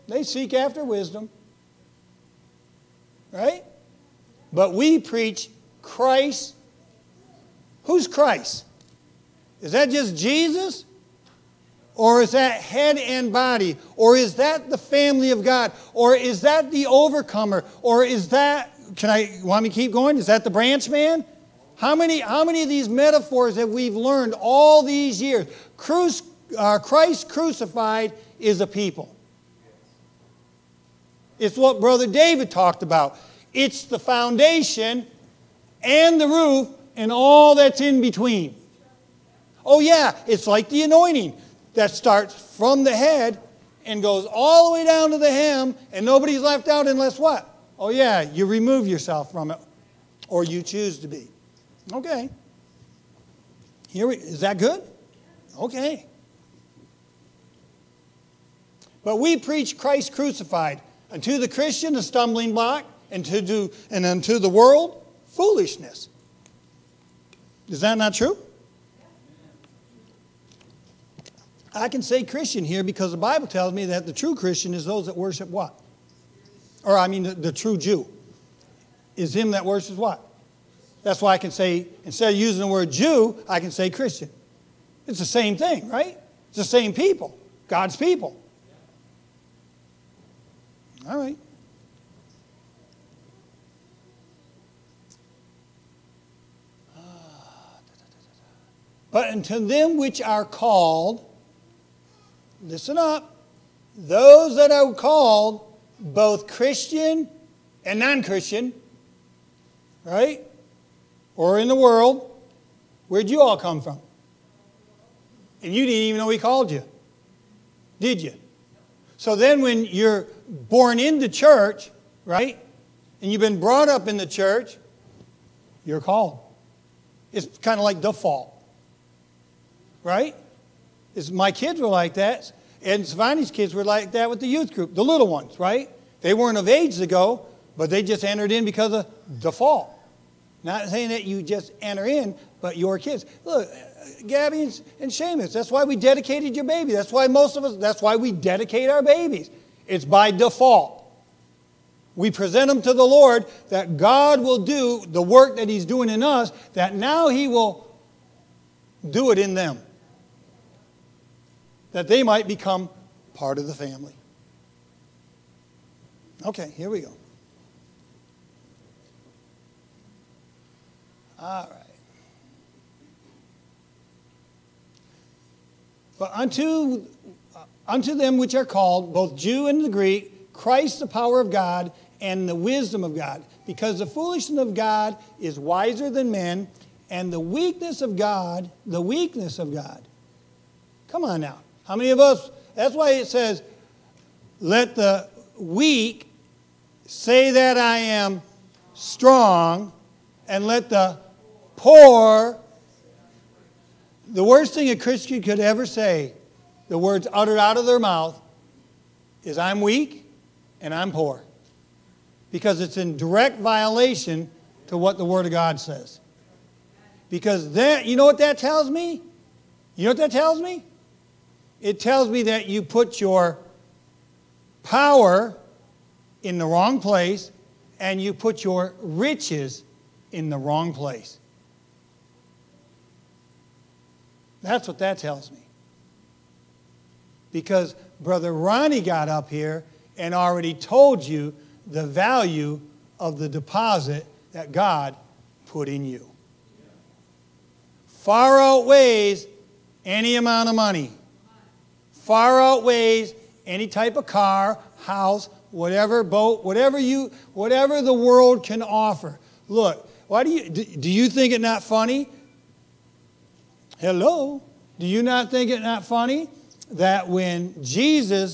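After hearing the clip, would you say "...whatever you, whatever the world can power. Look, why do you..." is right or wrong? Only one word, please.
wrong.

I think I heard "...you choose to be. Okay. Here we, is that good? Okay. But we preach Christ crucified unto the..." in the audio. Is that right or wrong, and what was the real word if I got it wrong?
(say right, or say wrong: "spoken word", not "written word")
right.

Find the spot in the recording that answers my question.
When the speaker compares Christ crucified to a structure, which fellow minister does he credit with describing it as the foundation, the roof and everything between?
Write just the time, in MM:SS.
00:31.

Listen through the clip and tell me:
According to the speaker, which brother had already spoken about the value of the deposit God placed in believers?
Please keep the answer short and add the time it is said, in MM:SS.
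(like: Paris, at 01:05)
Brother Ronnie, at 03:58.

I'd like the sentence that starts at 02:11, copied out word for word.
It's, my kids were like that, and Savani's kids were like that with the youth group, the little ones, right?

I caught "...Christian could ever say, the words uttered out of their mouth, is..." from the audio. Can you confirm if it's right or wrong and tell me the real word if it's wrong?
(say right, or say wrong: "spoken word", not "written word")
right.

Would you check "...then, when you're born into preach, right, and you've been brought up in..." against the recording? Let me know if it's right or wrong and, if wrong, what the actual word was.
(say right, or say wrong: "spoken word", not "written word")
wrong: "church", not "preach".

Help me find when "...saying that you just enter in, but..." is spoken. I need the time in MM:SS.
02:20.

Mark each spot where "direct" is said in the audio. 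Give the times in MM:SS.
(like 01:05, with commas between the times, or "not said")
03:33.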